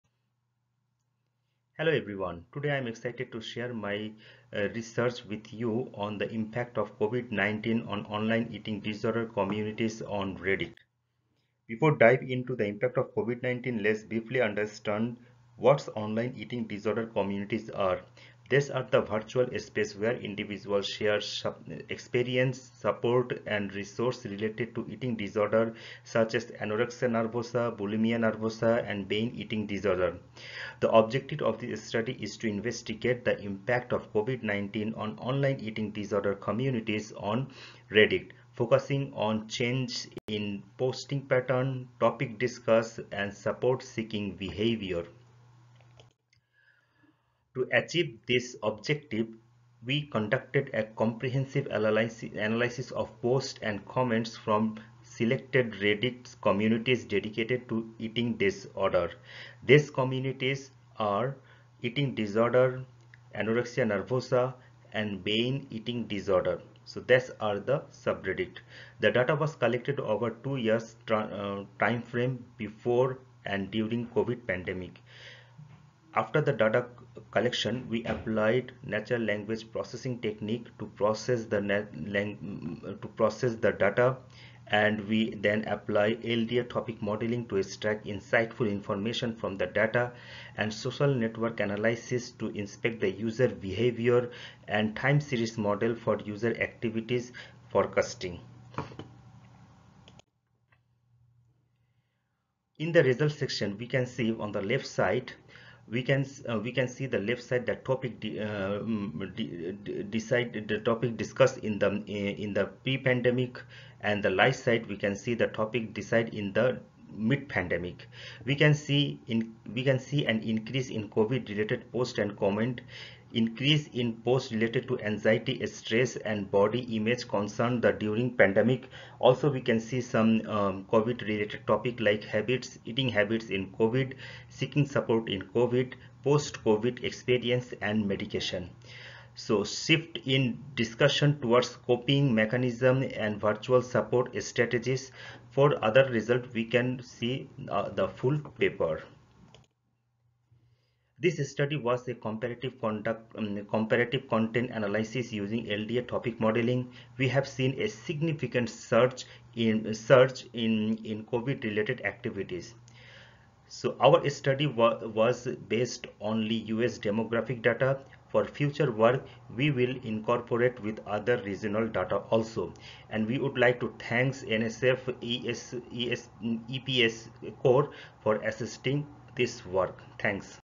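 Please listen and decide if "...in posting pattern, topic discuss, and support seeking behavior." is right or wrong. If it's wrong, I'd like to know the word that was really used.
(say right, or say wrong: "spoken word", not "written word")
right.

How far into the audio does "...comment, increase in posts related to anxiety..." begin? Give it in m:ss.
2:02.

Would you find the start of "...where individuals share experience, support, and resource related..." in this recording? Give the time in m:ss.
0:19.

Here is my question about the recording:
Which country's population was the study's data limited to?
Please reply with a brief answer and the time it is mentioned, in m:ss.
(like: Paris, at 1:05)
US, at 2:46.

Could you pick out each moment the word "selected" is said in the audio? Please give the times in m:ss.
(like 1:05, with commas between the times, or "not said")
0:55.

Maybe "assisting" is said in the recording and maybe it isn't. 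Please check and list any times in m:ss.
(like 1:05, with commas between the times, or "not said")
2:58.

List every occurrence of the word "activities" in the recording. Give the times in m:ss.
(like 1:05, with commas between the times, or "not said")
1:36, 2:42.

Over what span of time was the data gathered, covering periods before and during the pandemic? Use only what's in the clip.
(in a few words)
2 years.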